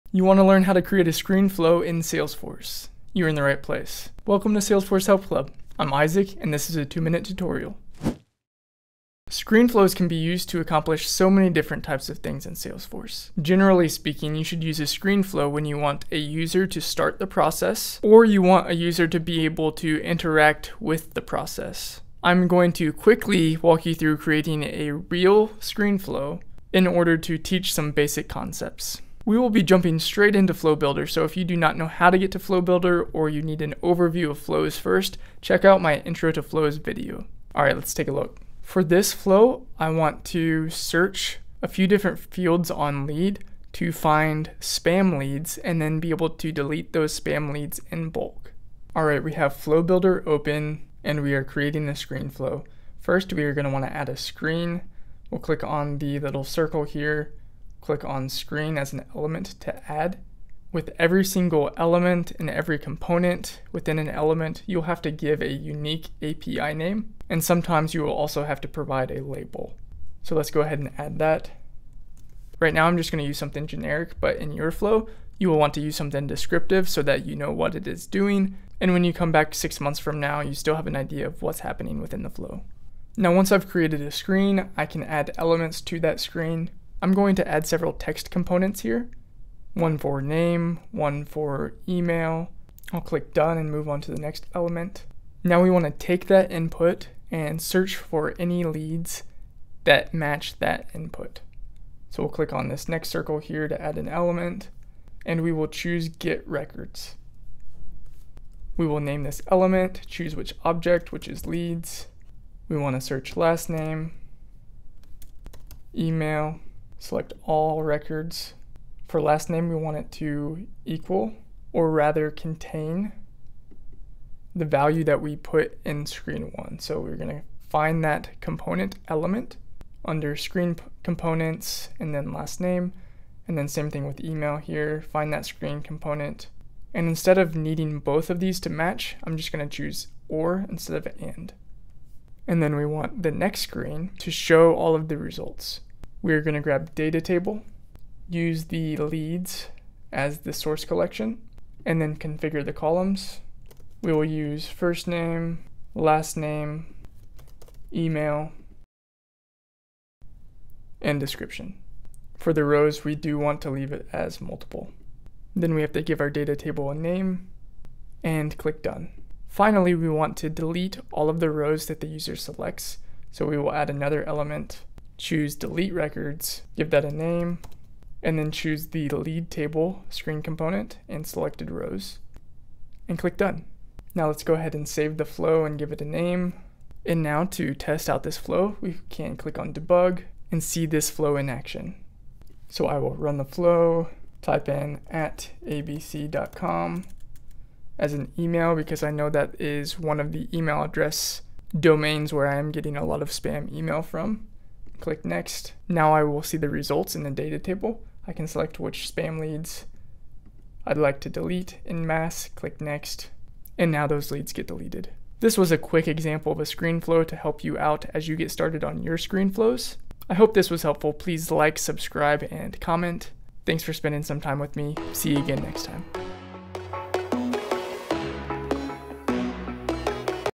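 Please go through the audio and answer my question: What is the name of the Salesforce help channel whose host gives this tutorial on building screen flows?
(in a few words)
Salesforce Help Club.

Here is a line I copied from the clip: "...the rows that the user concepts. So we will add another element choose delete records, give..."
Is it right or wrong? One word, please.
wrong.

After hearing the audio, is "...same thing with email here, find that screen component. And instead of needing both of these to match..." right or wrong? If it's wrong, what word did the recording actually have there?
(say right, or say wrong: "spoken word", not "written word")
right.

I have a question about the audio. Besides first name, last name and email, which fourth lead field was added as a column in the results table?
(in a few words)
description.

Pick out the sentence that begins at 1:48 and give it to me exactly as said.
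We will name this element, choose which object, which is leads.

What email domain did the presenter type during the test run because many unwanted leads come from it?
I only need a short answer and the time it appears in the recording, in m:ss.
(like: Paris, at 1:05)
abc.com, at 3:15.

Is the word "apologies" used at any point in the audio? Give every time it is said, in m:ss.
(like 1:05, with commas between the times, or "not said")
not said.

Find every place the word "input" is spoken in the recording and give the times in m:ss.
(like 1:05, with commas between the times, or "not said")
1:36, 1:40.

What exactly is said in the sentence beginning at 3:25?
Now I will see the results in the data table.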